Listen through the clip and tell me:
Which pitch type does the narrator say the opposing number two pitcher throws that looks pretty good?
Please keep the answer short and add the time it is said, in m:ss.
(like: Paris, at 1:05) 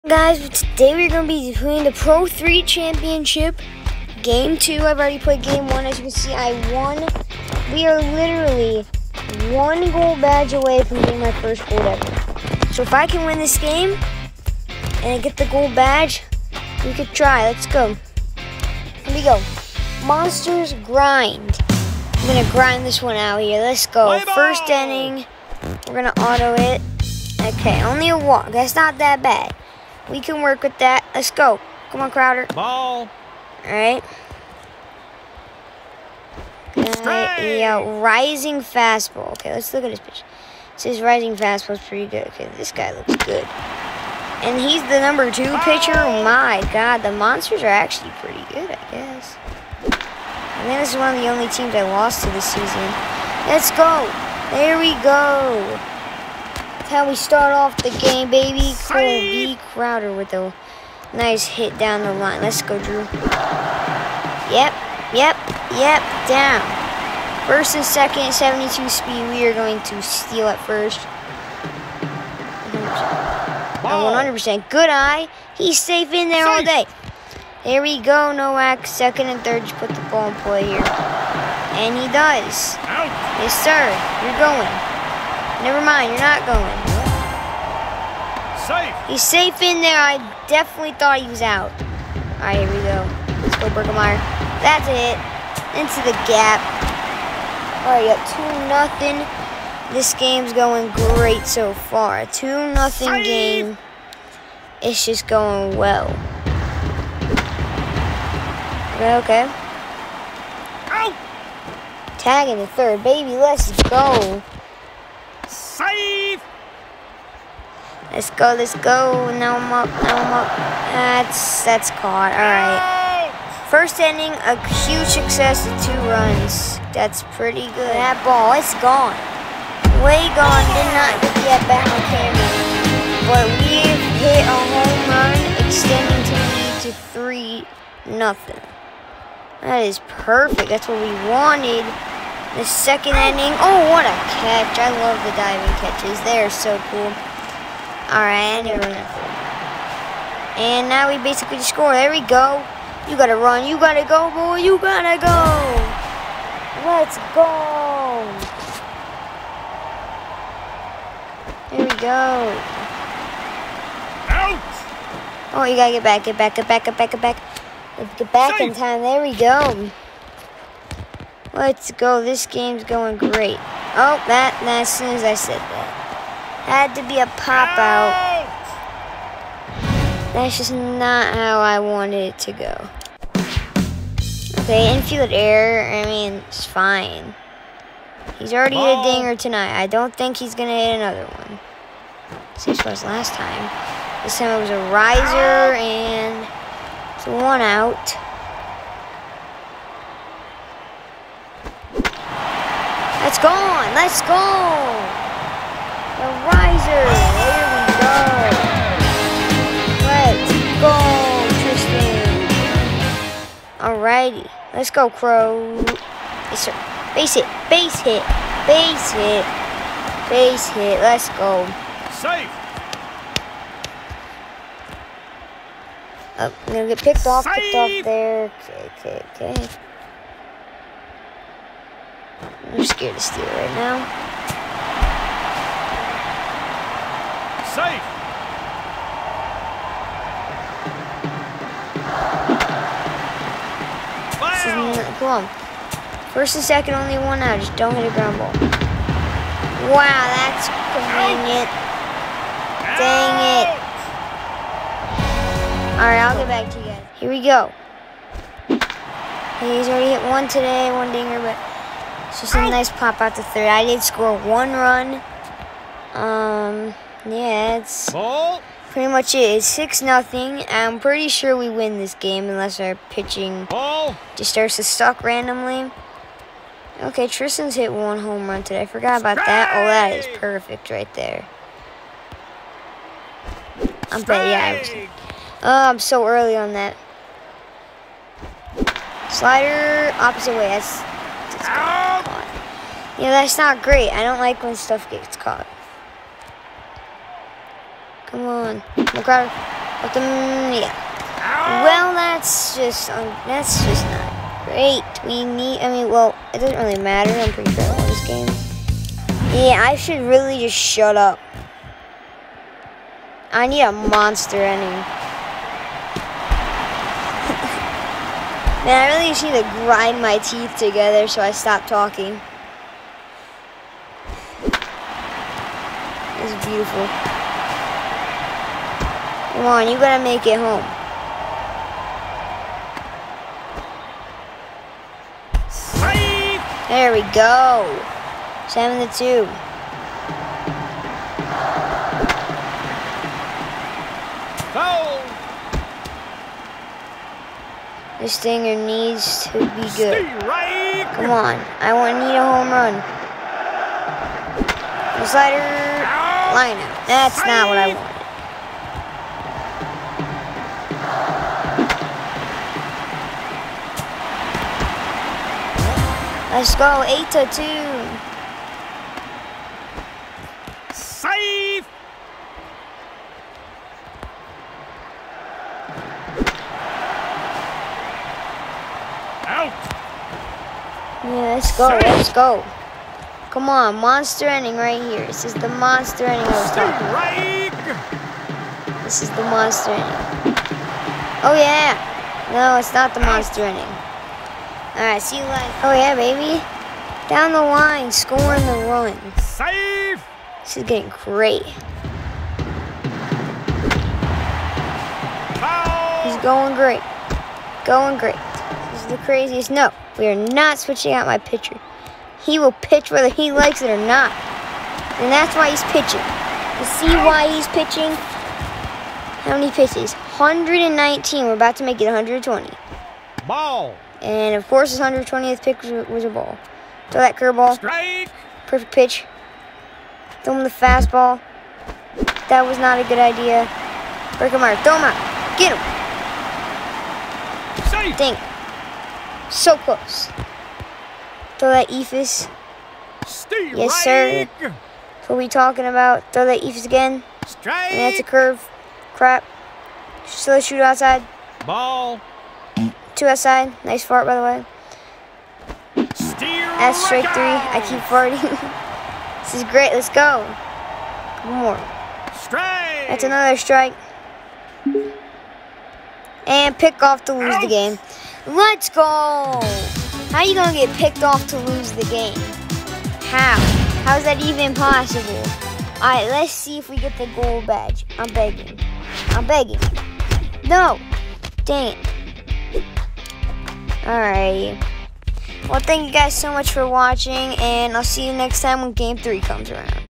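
Rising fastball, at 0:38.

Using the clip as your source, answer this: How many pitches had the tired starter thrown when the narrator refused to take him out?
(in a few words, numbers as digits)
119.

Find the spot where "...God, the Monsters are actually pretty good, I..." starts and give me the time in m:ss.
0:46.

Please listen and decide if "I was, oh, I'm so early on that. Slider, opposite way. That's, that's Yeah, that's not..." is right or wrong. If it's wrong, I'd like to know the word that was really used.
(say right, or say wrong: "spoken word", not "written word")
right.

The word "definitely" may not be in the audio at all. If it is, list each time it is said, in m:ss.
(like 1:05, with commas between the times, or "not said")
1:30.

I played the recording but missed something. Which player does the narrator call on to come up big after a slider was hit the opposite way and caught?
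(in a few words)
McGrath.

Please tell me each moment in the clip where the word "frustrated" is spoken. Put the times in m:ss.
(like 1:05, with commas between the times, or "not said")
not said.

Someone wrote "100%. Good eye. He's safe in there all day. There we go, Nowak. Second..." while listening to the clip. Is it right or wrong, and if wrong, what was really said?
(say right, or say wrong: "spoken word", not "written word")
right.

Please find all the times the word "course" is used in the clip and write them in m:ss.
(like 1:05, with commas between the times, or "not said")
7:04.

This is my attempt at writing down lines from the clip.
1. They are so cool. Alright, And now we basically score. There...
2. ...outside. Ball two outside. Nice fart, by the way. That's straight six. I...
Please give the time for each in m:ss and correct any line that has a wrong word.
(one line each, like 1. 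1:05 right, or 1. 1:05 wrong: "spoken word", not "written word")
1. 2:26 right
2. 7:30 wrong: "three", not "six".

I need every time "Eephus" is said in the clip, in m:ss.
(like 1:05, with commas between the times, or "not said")
7:21, 7:26.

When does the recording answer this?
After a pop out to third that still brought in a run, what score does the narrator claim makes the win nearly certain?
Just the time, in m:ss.
4:29.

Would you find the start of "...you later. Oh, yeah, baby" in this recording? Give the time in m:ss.
6:35.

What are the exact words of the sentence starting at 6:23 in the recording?
Come on, monster ending right here.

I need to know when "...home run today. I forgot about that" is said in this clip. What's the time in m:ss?
4:38.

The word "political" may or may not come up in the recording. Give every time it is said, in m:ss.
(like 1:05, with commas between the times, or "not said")
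not said.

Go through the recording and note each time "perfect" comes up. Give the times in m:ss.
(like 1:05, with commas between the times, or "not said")
2:20, 4:40, 7:08.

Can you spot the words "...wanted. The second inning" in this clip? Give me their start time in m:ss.
2:21.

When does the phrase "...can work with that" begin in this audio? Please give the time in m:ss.
0:30.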